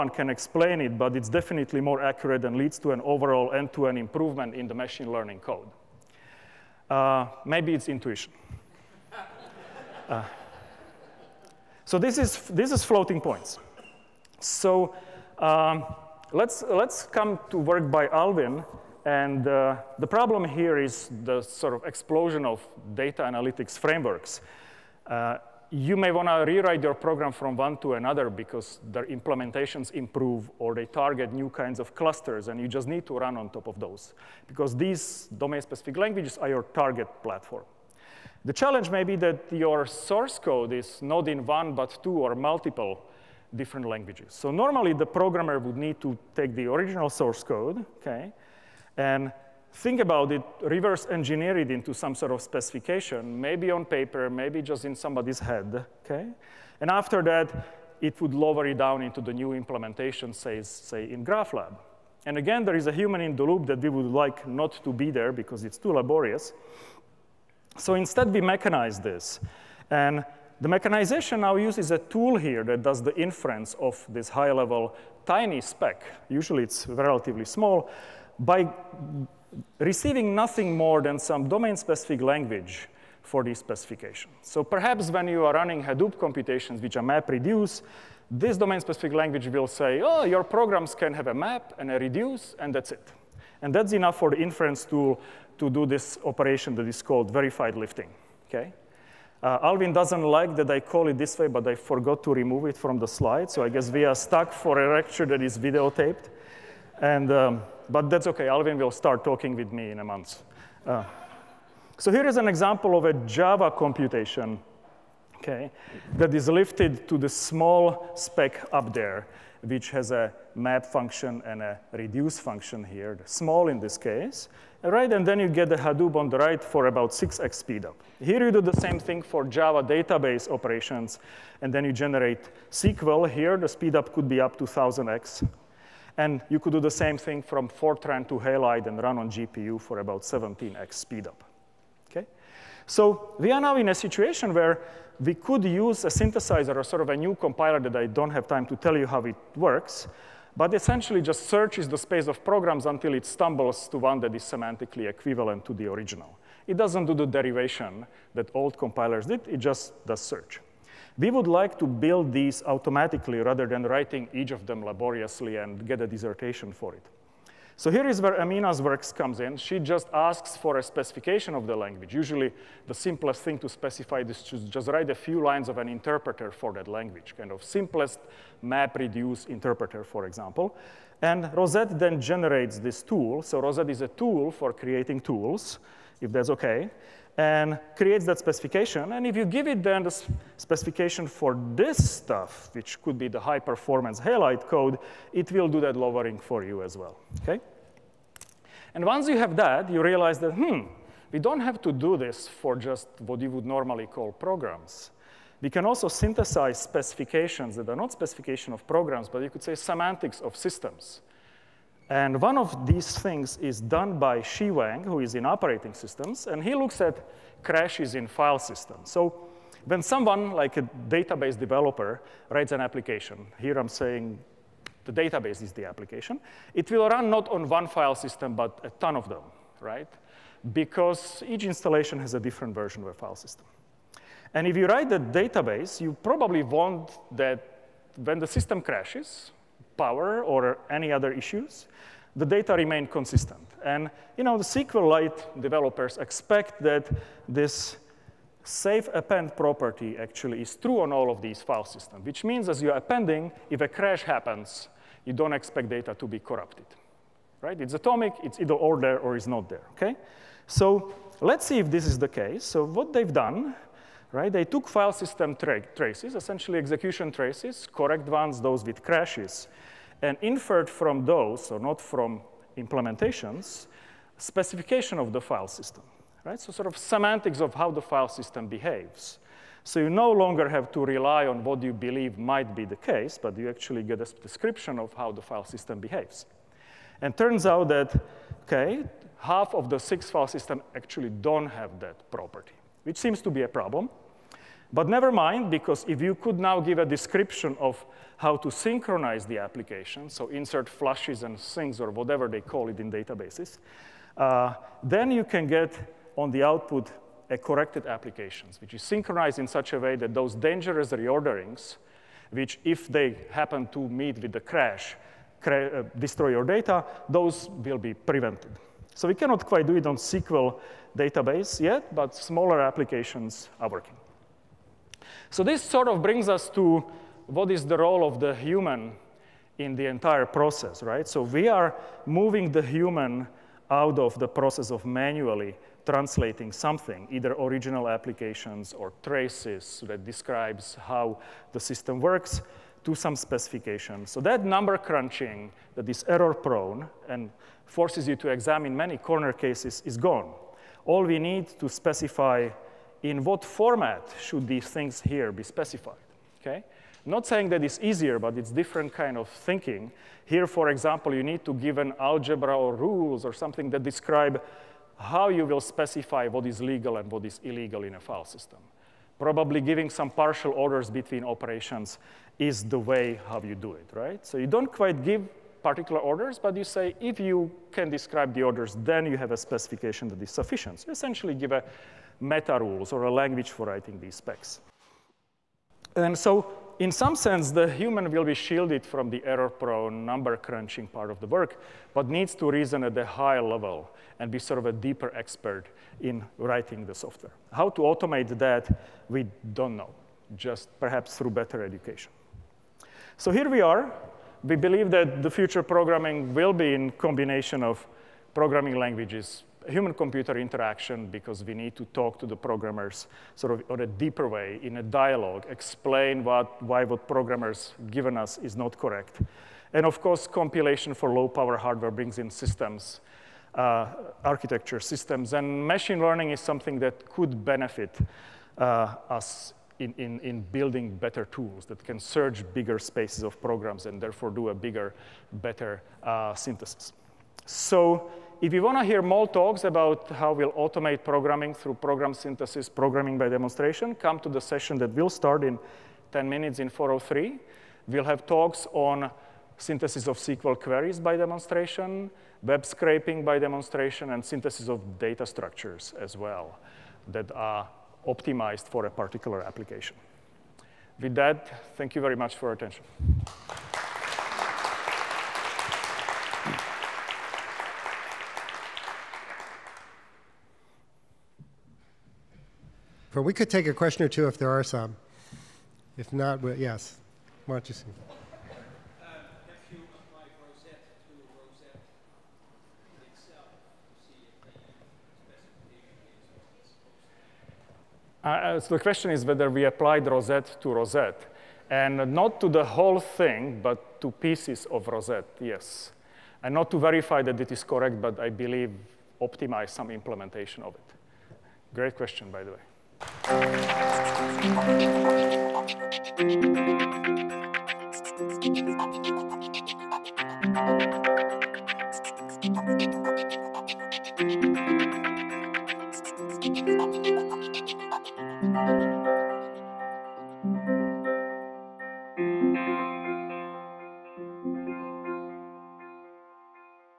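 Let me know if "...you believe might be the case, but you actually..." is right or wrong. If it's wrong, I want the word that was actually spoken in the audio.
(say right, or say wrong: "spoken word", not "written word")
right.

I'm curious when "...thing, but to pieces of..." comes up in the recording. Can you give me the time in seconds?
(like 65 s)
493 s.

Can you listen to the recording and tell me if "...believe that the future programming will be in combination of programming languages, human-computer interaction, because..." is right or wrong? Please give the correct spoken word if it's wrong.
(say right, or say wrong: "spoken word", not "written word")
right.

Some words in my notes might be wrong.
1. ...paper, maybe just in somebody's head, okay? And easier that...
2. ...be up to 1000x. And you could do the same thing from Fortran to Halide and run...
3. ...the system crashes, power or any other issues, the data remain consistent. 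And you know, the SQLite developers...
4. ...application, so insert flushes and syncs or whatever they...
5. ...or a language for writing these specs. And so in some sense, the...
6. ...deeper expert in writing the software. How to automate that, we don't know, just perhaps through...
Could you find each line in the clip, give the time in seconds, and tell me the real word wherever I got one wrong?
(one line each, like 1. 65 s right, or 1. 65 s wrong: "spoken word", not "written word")
1. 53 s wrong: "after", not "easier"
2. 134 s right
3. 238 s right
4. 299 s right
5. 383 s right
6. 394 s right.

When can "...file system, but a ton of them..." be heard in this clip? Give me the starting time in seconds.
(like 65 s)
227 s.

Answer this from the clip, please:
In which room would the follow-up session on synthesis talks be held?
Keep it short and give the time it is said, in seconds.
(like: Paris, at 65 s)
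403, at 446 s.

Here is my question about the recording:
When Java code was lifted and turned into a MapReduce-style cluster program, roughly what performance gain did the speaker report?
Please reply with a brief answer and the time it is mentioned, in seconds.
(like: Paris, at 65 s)
6x, at 127 s.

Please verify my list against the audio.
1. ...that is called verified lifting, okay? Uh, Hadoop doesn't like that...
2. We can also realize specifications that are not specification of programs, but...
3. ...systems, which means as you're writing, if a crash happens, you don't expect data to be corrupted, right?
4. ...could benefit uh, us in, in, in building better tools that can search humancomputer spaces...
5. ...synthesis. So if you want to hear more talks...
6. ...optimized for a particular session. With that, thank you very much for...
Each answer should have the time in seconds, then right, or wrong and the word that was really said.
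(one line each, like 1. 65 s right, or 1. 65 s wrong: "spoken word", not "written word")
1. 96 s wrong: "Alvin", not "Hadoop"
2. 205 s wrong: "synthesize", not "realize"
3. 251 s wrong: "appending", not "writing"
4. 427 s wrong: "bigger", not "humancomputer"
5. 436 s right
6. 458 s wrong: "application", not "session".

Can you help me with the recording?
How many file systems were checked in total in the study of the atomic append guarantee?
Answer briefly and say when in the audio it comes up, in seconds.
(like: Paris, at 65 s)
6, at 289 s.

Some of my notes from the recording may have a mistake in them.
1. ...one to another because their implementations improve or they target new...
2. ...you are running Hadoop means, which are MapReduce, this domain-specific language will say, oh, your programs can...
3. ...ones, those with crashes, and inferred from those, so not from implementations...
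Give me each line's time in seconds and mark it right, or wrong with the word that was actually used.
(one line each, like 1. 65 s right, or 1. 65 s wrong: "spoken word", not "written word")
1. 27 s right
2. 85 s wrong: "computations", not "means"
3. 268 s right.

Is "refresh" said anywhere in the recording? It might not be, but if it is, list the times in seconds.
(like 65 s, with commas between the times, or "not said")
not said.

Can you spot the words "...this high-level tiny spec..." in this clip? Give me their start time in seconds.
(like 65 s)
74 s.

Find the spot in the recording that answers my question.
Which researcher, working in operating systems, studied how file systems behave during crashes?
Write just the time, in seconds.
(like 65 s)
214 s.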